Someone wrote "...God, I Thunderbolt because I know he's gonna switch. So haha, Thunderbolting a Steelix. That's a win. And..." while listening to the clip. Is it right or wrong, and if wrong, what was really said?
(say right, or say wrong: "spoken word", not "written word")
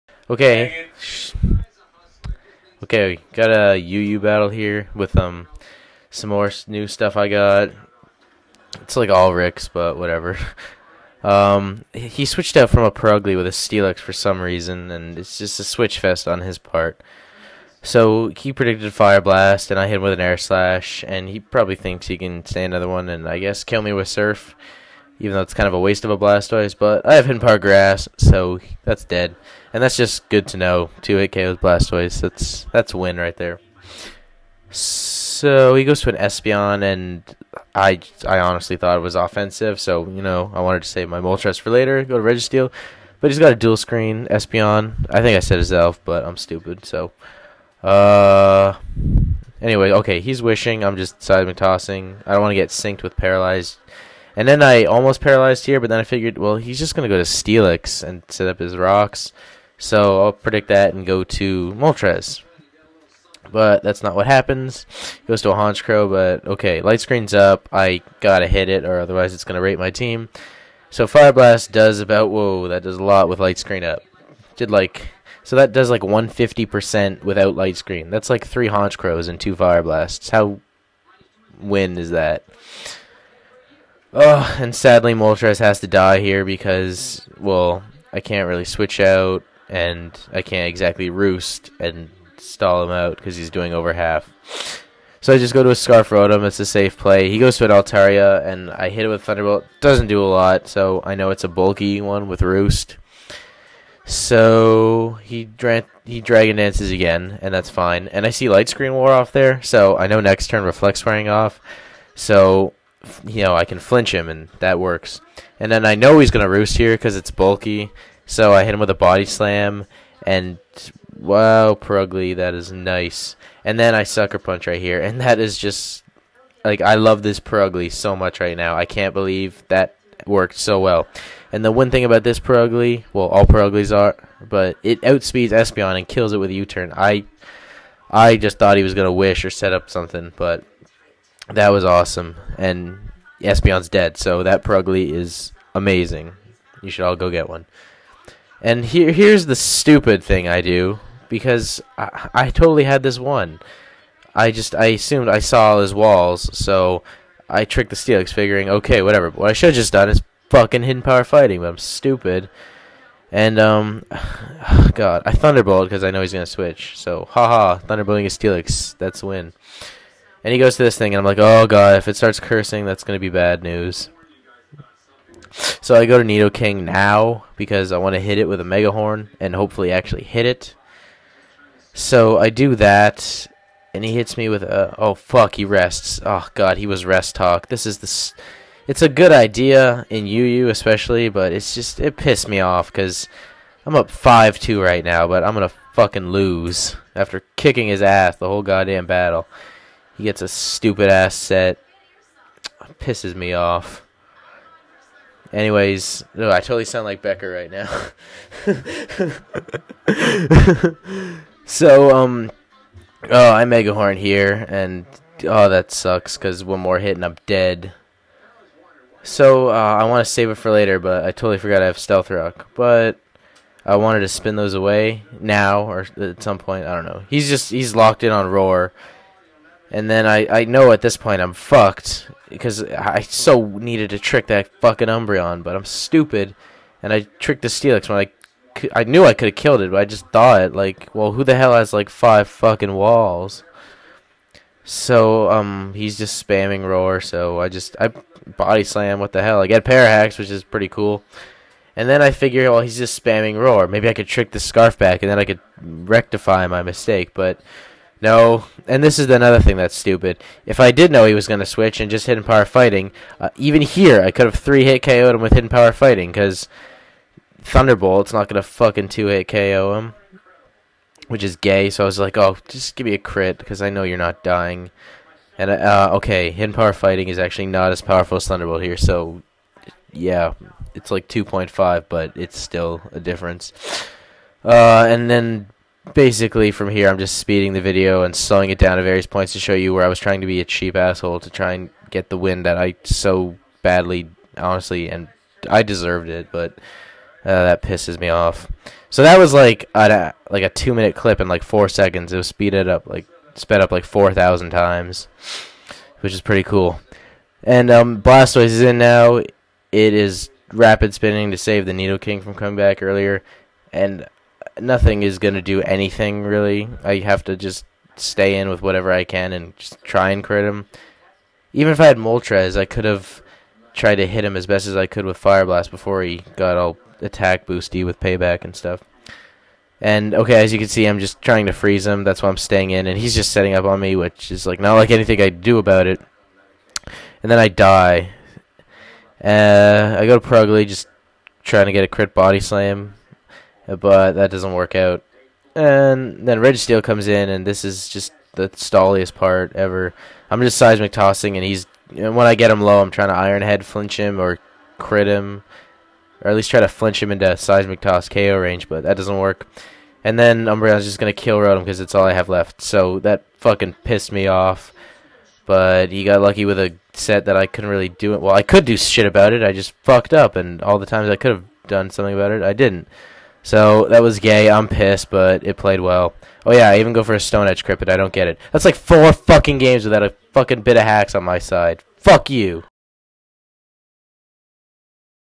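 right.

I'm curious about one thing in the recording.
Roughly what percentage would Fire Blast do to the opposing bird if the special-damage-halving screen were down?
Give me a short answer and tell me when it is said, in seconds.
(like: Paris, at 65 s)
150%, at 76 s.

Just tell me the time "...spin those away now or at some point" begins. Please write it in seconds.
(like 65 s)
224 s.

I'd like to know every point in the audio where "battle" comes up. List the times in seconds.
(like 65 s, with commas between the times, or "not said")
4 s, 199 s.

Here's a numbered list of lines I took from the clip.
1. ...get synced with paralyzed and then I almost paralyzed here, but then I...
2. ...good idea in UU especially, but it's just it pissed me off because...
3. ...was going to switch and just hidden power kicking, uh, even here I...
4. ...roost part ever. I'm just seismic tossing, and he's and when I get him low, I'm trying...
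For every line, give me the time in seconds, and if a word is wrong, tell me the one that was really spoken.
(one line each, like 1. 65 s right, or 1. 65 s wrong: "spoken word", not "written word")
1. 52 s right
2. 189 s right
3. 261 s wrong: "fighting", not "kicking"
4. 348 s wrong: "stalliest", not "roost".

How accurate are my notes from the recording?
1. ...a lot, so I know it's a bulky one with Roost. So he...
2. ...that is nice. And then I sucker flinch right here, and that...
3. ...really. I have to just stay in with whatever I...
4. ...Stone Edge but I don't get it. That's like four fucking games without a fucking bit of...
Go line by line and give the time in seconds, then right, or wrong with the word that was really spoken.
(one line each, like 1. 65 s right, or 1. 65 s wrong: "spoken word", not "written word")
1. 100 s right
2. 122 s wrong: "punch", not "flinch"
3. 316 s right
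4. 377 s right.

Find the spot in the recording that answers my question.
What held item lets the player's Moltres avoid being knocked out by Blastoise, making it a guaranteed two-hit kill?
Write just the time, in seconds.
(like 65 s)
27 s.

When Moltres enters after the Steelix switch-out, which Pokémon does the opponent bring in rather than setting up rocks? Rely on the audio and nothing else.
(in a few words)
Honchkrow.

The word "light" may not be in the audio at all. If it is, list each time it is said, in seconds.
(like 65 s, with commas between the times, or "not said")
66 s, 73 s, 77 s, 108 s.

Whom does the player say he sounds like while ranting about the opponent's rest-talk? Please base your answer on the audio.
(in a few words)
Becker.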